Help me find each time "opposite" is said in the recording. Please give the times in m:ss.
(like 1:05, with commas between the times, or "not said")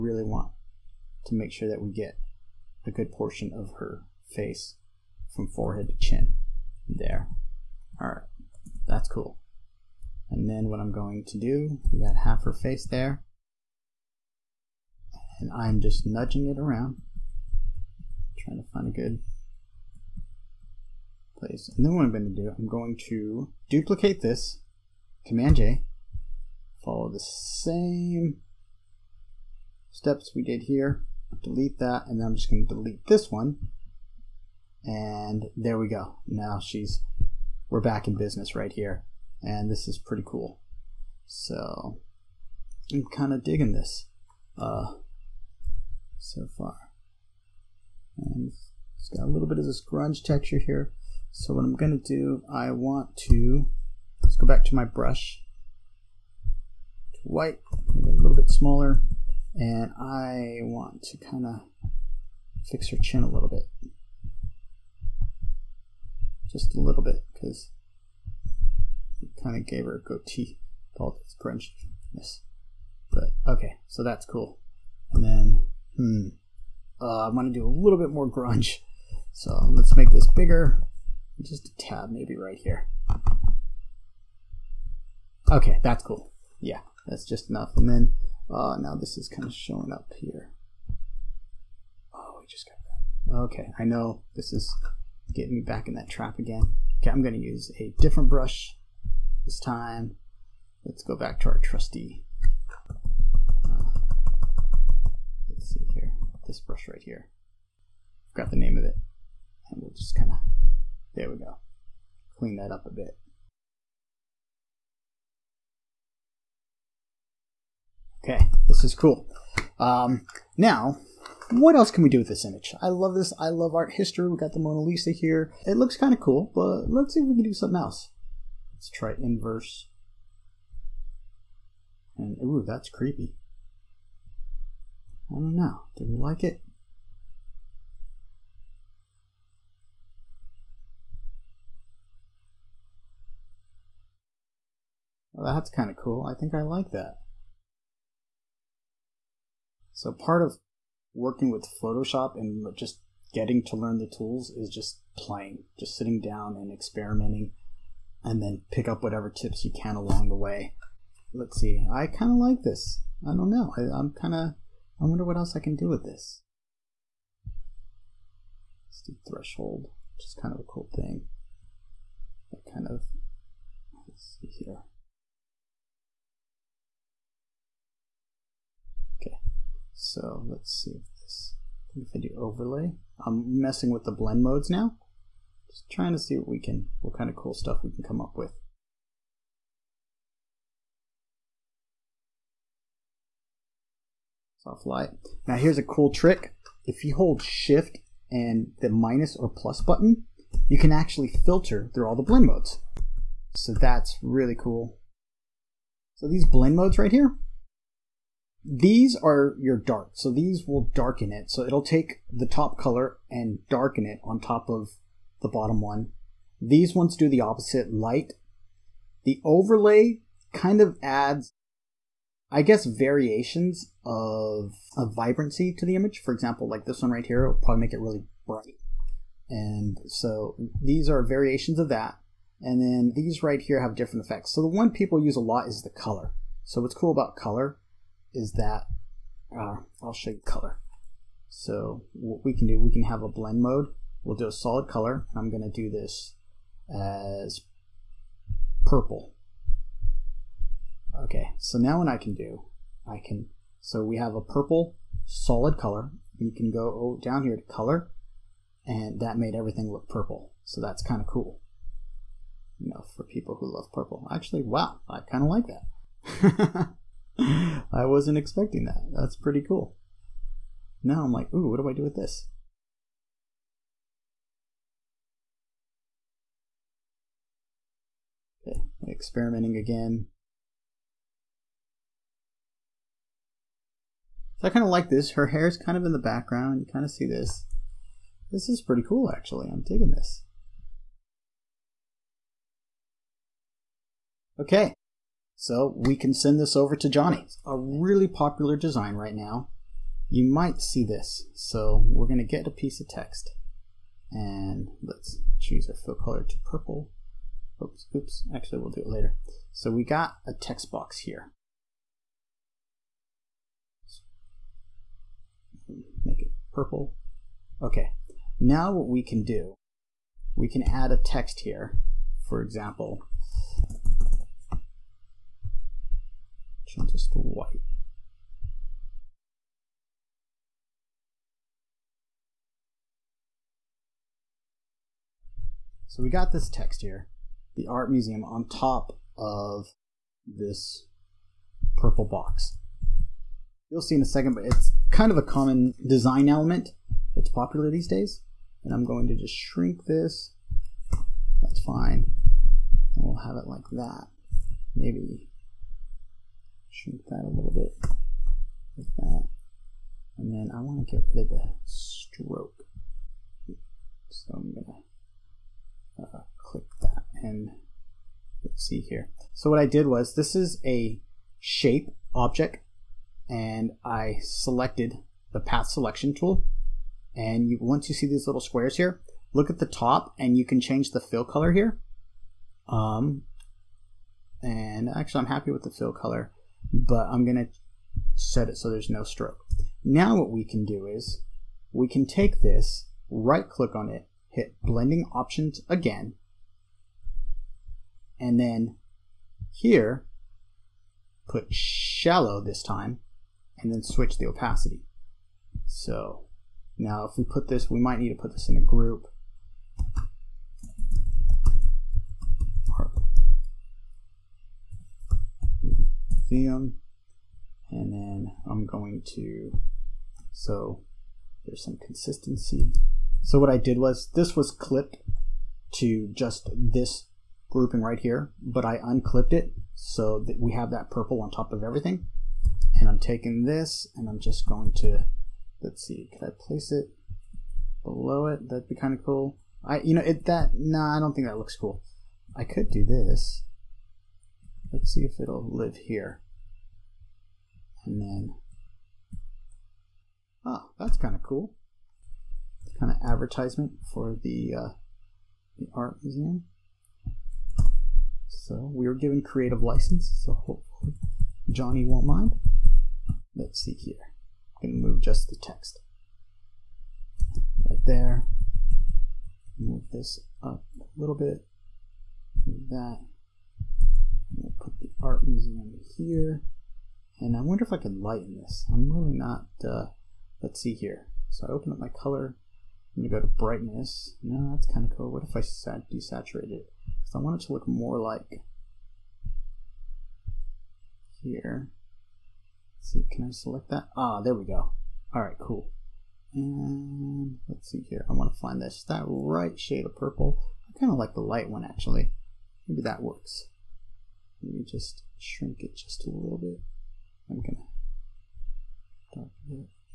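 3:37.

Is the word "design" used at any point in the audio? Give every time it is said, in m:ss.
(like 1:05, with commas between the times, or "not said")
4:58, 5:46.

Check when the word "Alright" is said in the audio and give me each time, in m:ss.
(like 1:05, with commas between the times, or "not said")
0:08.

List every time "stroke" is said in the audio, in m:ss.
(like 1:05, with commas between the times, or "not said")
6:01, 6:29.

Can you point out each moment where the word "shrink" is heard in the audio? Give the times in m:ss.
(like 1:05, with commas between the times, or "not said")
5:49, 5:57, 8:25.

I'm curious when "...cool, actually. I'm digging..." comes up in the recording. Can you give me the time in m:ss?
4:49.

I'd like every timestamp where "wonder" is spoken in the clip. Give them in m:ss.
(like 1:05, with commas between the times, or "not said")
2:45, 7:57.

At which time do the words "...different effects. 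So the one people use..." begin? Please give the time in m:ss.
3:53.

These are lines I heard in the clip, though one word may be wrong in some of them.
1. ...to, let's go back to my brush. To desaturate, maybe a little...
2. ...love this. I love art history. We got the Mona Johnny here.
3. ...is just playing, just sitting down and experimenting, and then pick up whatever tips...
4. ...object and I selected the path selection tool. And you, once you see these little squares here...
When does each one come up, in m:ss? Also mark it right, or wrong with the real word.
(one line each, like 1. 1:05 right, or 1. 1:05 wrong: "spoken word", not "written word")
1. 0:53 wrong: "white", not "desaturate"
2. 2:02 wrong: "Lisa", not "Johnny"
3. 2:34 right
4. 6:12 right.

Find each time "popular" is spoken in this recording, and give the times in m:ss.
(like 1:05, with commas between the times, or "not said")
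4:58, 5:47.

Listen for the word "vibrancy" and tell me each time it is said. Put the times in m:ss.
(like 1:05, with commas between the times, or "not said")
3:45.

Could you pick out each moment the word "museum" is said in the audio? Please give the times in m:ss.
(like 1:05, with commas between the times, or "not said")
5:38, 7:36, 7:55.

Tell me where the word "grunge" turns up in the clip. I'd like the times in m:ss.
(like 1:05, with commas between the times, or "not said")
0:49, 1:18.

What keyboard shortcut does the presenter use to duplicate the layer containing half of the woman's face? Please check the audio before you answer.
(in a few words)
Command J.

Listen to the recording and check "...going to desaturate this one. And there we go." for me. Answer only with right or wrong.
wrong.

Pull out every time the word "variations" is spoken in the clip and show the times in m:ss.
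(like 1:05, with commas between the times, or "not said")
3:42, 3:51.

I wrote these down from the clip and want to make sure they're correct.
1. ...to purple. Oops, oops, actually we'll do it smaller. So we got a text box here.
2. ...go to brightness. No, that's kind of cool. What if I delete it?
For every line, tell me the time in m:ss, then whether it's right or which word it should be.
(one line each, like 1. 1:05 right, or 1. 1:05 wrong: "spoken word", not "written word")
1. 5:06 wrong: "later", not "smaller"
2. 8:03 wrong: "desaturate", not "delete".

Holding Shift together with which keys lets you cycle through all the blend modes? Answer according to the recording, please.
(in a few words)
minus or plus.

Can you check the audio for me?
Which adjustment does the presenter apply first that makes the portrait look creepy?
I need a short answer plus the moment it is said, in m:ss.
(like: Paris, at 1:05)
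Inverse, at 2:09.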